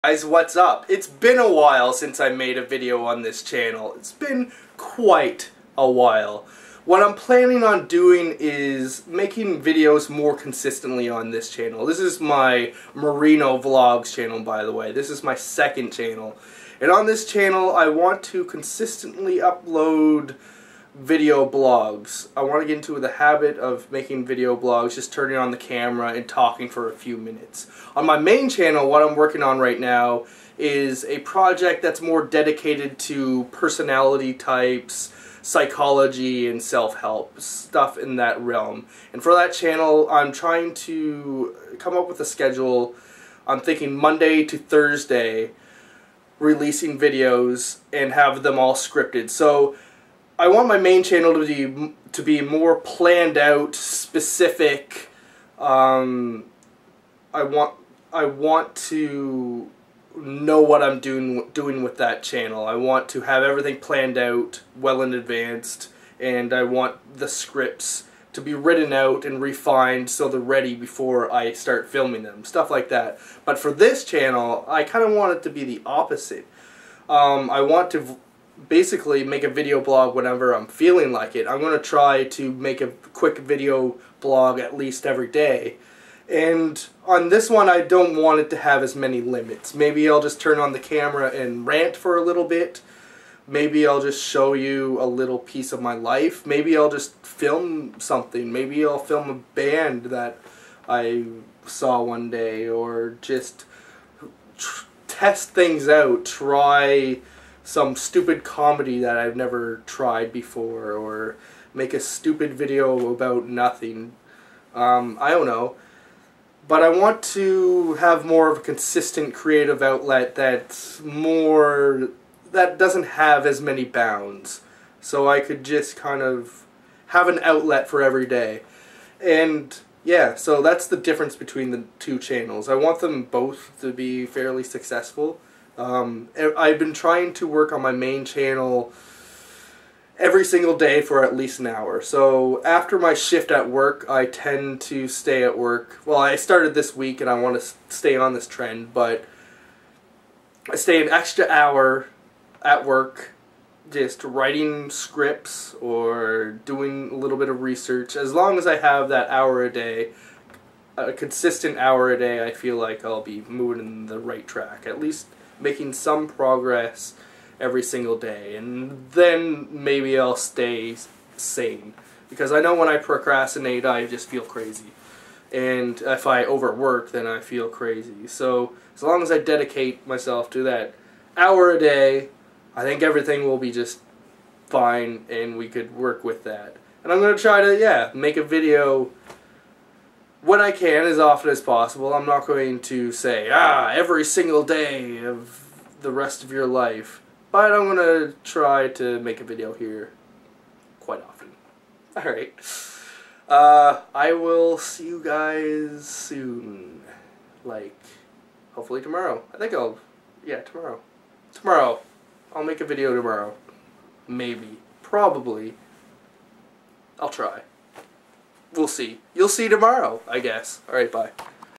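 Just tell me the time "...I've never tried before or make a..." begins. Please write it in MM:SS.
01:49.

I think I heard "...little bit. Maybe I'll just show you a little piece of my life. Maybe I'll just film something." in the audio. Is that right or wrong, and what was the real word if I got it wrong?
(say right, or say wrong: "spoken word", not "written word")
right.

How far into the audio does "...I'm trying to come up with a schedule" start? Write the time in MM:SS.
00:40.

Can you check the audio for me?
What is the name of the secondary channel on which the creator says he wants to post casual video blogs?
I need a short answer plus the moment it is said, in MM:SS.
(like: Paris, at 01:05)
Marino vlogs, at 00:12.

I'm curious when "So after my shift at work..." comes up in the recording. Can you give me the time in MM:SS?
02:22.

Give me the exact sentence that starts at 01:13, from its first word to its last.
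But for this channel, I kind of want it to be the opposite.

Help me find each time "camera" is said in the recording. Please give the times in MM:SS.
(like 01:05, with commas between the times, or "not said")
00:25, 01:30.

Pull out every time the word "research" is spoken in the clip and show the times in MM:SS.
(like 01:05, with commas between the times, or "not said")
02:37.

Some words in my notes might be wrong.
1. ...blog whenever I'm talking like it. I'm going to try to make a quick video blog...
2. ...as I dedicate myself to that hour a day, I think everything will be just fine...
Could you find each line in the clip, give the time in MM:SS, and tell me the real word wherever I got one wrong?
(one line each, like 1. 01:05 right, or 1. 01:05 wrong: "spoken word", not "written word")
1. 01:19 wrong: "feeling", not "talking"
2. 02:59 right.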